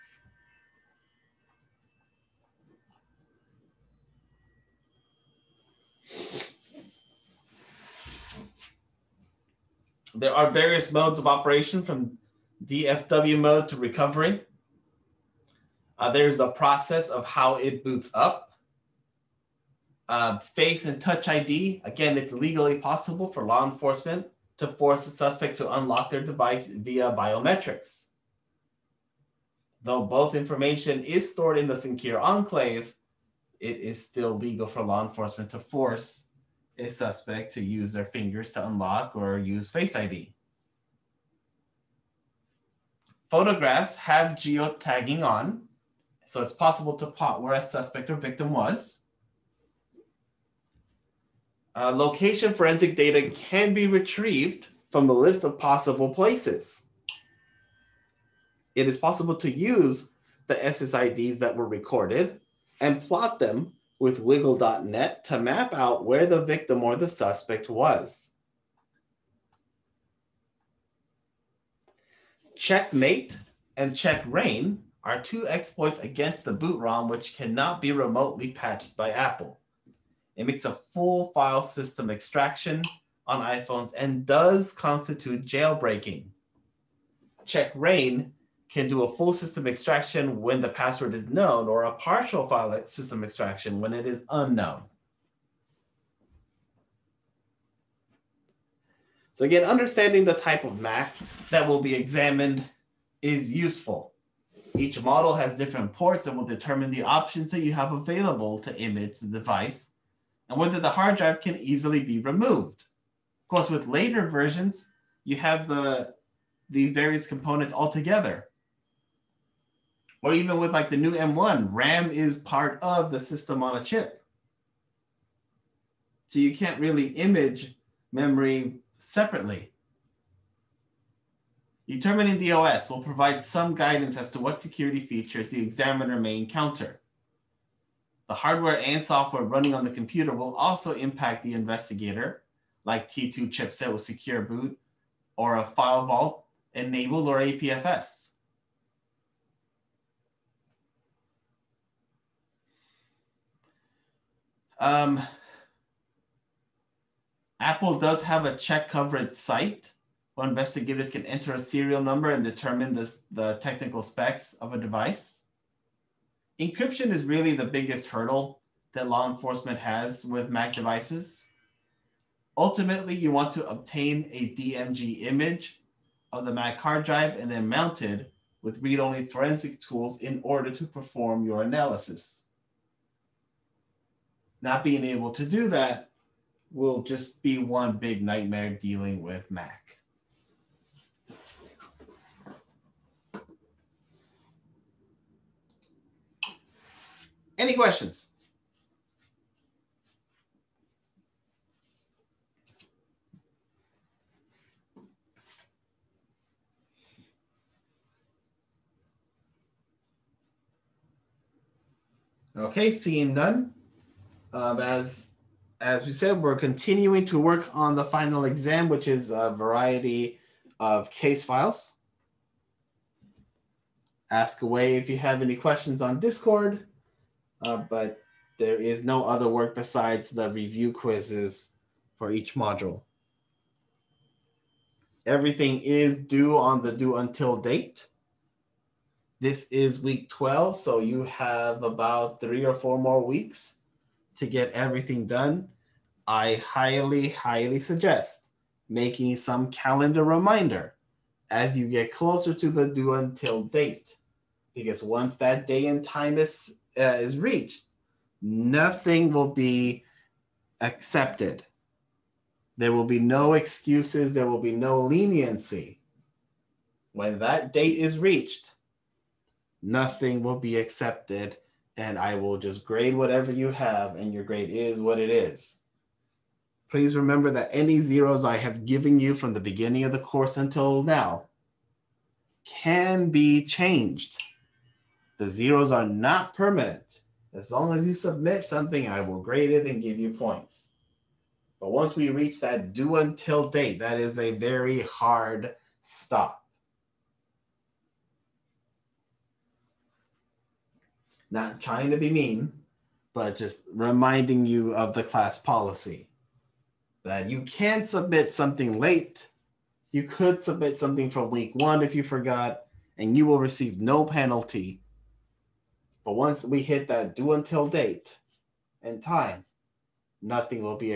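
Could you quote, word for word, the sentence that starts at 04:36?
Please remember that any zeros I have given you from the beginning of the course until now can be changed.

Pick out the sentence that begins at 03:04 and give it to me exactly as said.
Not being able to do that will just be one big nightmare dealing with Mac.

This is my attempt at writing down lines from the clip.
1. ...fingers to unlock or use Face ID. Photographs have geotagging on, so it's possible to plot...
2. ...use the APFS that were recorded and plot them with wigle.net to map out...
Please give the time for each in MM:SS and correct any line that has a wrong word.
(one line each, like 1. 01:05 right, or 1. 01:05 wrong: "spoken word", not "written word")
1. 00:38 right
2. 00:59 wrong: "SSIDs", not "APFS".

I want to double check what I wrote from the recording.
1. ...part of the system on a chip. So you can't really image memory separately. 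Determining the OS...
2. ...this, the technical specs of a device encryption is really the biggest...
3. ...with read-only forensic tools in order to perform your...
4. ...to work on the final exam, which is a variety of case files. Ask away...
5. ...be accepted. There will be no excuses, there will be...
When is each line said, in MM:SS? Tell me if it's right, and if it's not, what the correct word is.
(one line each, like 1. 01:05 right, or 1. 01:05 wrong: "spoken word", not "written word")
1. 02:02 right
2. 02:42 right
3. 02:58 right
4. 03:37 right
5. 04:19 right.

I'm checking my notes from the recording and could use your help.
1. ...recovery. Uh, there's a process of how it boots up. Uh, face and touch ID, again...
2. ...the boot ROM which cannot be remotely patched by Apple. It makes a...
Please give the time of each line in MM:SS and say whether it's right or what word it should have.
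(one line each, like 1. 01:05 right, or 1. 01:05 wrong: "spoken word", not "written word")
1. 00:13 right
2. 01:16 right.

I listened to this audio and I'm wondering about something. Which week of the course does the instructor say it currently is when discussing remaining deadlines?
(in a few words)
12.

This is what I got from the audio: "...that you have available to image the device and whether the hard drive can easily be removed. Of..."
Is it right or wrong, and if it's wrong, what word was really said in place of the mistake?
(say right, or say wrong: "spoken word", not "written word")
right.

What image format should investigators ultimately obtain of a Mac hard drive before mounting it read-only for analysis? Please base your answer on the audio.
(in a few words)
DMG.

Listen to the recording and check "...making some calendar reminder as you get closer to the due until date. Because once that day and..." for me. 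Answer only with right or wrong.
right.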